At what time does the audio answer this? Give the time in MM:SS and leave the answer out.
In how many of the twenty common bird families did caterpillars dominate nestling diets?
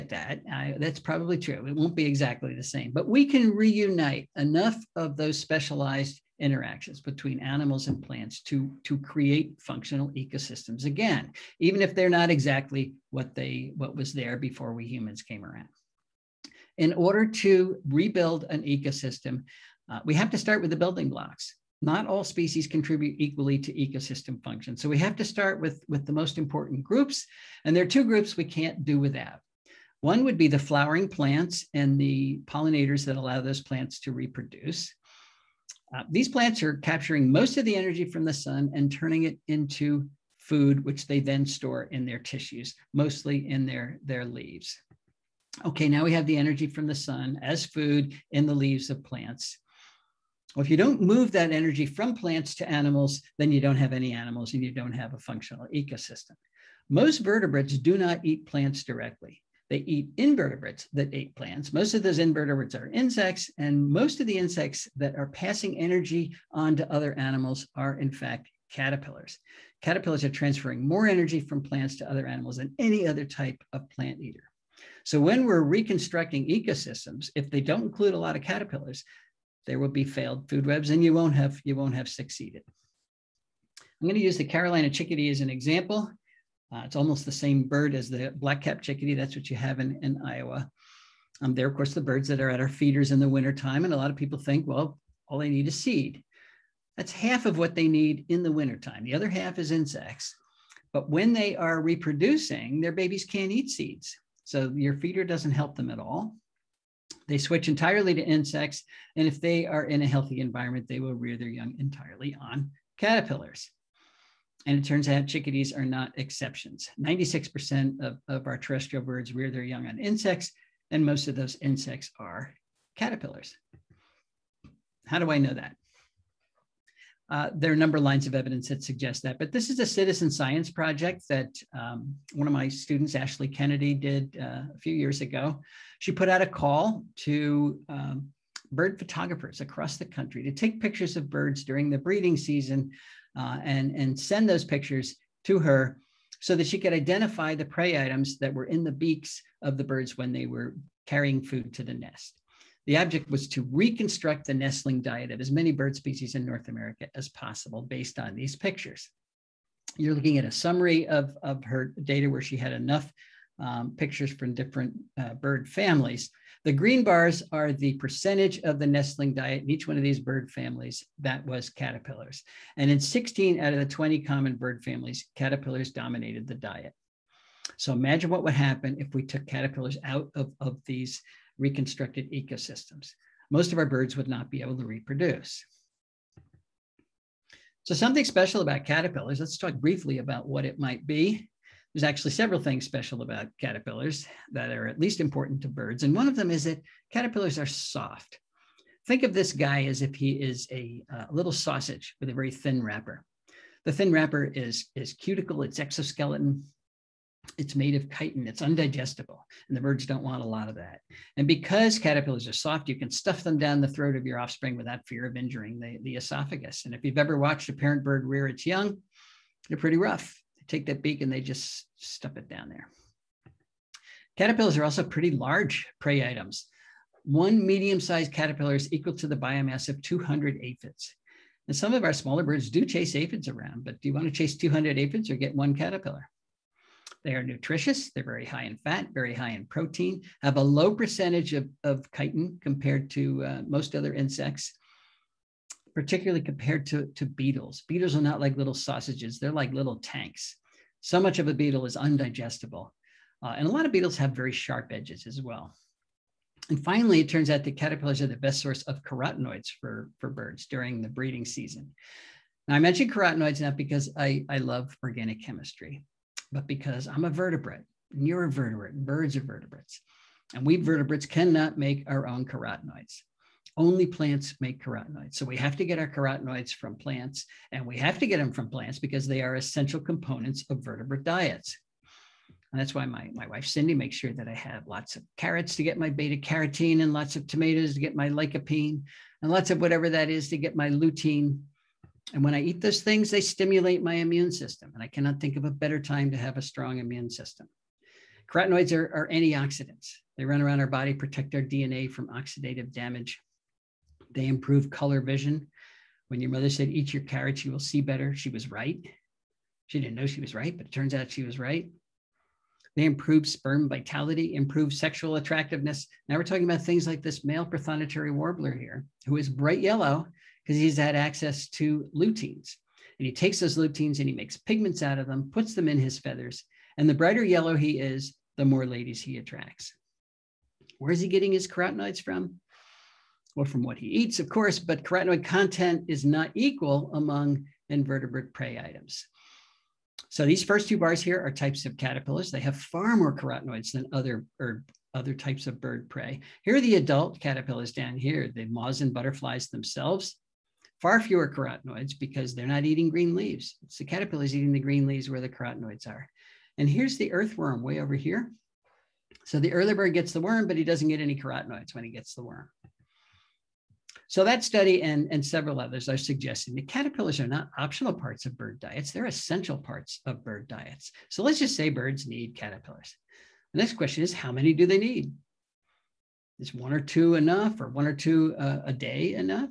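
02:53.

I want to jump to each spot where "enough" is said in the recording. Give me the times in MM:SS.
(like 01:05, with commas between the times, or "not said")
00:04, 02:42, 06:17.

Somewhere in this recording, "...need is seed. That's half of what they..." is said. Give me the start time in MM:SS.
01:35.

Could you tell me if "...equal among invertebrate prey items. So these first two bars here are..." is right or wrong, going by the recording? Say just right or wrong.
right.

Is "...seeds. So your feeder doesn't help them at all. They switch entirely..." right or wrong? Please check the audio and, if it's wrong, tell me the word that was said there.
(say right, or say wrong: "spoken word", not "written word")
right.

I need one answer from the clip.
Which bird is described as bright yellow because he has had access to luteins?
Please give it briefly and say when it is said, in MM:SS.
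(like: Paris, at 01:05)
Prothonotary warbler, at 05:17.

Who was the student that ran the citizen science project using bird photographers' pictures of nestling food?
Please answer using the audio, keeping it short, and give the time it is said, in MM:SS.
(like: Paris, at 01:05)
Ashley Kennedy, at 02:13.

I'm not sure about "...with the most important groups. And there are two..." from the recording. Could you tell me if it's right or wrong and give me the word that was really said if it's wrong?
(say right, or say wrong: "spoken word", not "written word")
right.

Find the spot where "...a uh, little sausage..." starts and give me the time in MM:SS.
03:21.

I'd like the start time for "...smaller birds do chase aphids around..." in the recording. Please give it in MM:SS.
03:52.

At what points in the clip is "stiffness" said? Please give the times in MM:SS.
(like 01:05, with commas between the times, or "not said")
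not said.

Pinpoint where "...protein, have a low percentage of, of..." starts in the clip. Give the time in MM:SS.
03:59.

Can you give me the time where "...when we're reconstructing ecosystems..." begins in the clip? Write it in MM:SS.
01:15.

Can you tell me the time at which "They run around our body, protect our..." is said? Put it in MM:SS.
05:00.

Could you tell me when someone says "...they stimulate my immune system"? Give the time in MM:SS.
04:53.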